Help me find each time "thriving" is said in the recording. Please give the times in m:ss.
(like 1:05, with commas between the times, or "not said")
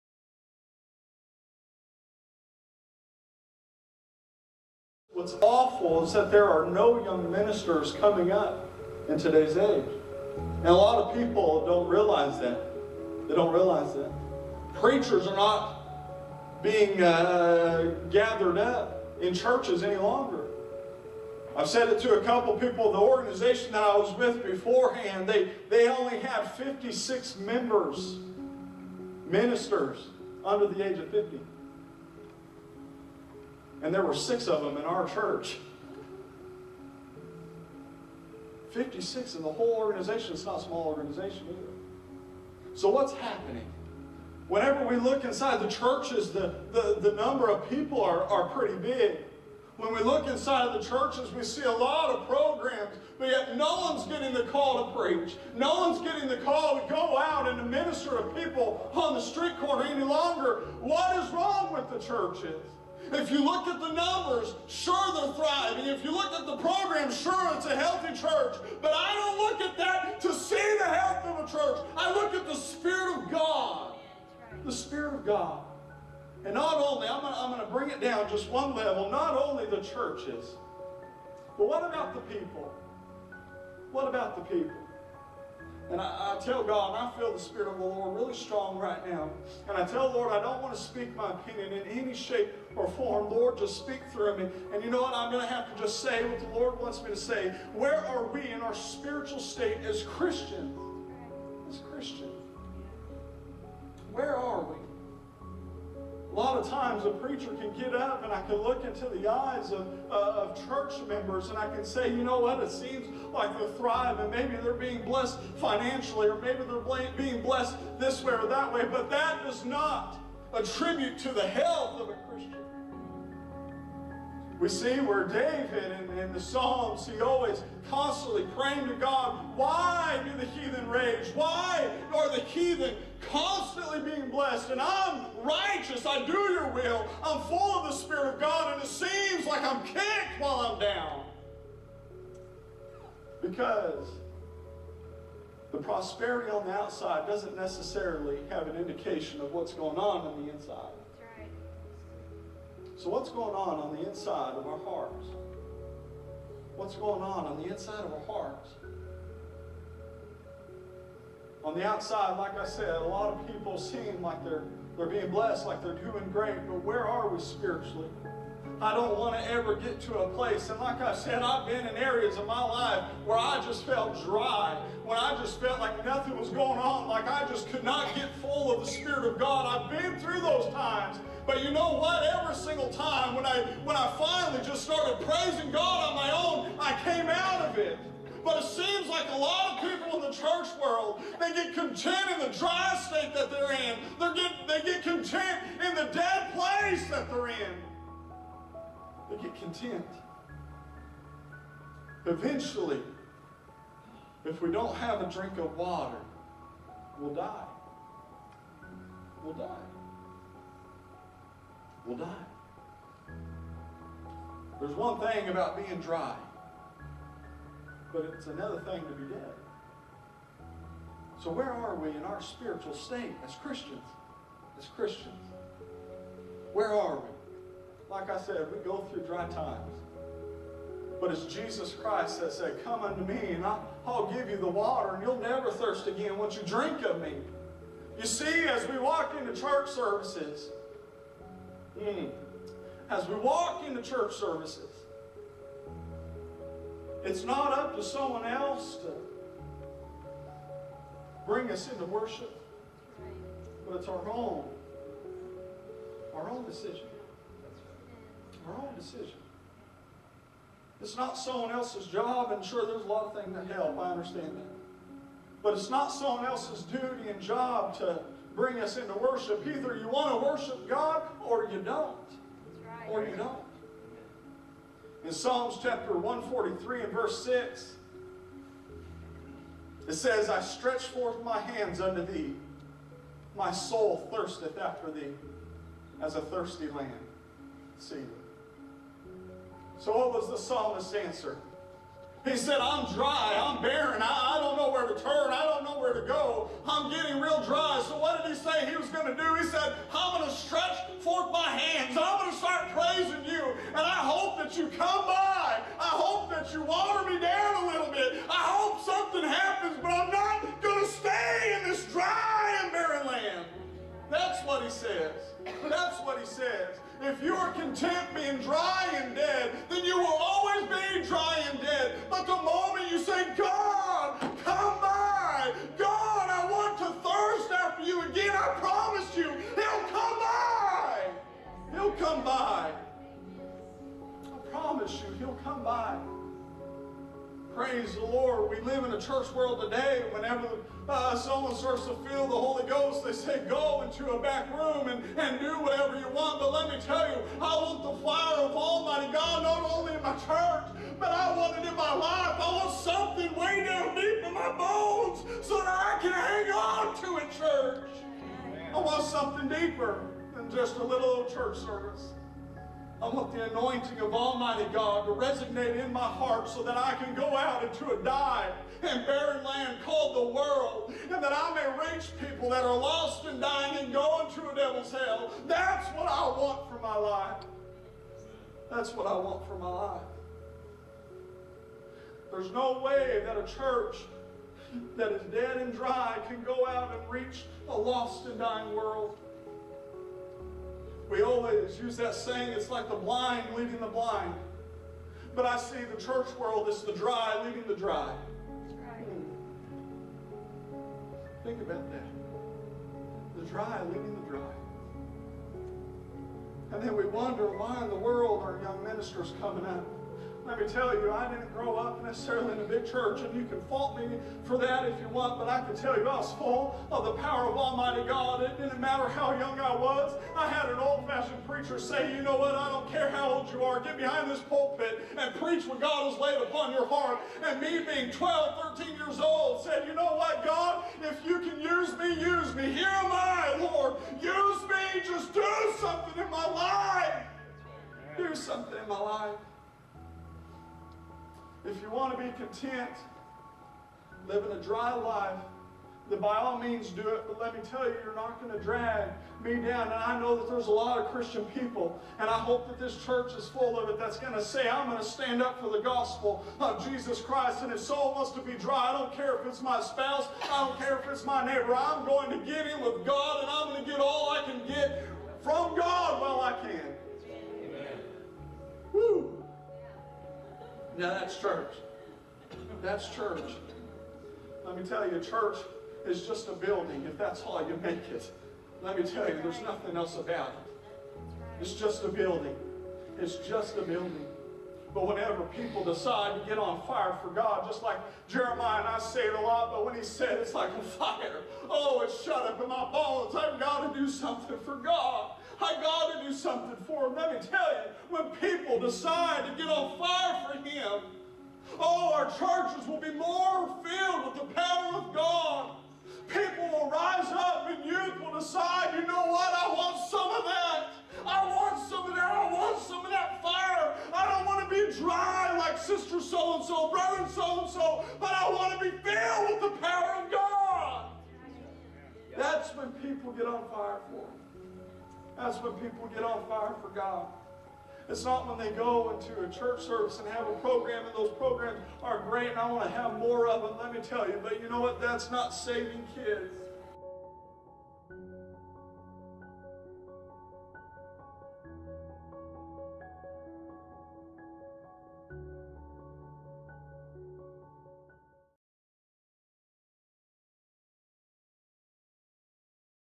1:05, 1:53.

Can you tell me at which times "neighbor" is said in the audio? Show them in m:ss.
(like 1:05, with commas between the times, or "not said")
7:41.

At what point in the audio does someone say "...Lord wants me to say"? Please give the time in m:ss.
1:36.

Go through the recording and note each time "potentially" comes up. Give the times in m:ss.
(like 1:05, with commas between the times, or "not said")
not said.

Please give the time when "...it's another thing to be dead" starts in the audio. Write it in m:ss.
3:38.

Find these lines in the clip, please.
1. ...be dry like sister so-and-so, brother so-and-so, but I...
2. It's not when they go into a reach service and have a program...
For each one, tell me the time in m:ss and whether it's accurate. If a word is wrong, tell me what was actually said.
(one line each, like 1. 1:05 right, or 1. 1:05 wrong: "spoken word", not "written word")
1. 8:34 right
2. 8:48 wrong: "church", not "reach".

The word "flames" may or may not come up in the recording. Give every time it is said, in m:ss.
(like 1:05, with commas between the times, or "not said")
not said.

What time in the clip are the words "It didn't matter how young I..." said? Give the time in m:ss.
6:58.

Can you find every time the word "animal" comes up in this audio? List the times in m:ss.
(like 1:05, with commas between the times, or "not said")
not said.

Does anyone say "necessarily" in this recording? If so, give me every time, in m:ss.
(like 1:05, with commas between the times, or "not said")
2:27, 6:52.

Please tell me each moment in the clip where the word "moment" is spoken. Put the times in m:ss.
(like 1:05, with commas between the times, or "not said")
5:22.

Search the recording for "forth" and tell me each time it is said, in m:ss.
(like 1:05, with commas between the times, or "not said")
4:41, 5:01.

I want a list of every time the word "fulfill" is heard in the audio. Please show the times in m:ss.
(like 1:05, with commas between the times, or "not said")
not said.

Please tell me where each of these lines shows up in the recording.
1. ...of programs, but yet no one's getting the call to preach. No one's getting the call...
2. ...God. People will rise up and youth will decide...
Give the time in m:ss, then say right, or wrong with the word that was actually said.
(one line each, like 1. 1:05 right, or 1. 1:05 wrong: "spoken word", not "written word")
1. 0:52 right
2. 8:25 right.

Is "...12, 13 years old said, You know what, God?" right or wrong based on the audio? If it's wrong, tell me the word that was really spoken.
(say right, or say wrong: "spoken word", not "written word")
right.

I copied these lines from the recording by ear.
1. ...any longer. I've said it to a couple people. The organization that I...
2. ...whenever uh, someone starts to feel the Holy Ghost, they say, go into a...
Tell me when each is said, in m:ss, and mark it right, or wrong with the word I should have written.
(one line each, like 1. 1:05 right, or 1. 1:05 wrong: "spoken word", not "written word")
1. 0:19 right
2. 5:40 right.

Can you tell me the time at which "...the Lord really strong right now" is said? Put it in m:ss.
1:27.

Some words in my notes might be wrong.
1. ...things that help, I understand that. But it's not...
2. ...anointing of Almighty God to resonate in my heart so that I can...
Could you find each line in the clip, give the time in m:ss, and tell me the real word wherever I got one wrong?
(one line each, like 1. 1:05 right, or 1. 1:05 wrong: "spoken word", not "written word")
1. 4:23 right
2. 6:03 right.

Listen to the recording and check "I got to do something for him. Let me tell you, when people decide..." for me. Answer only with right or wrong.
right.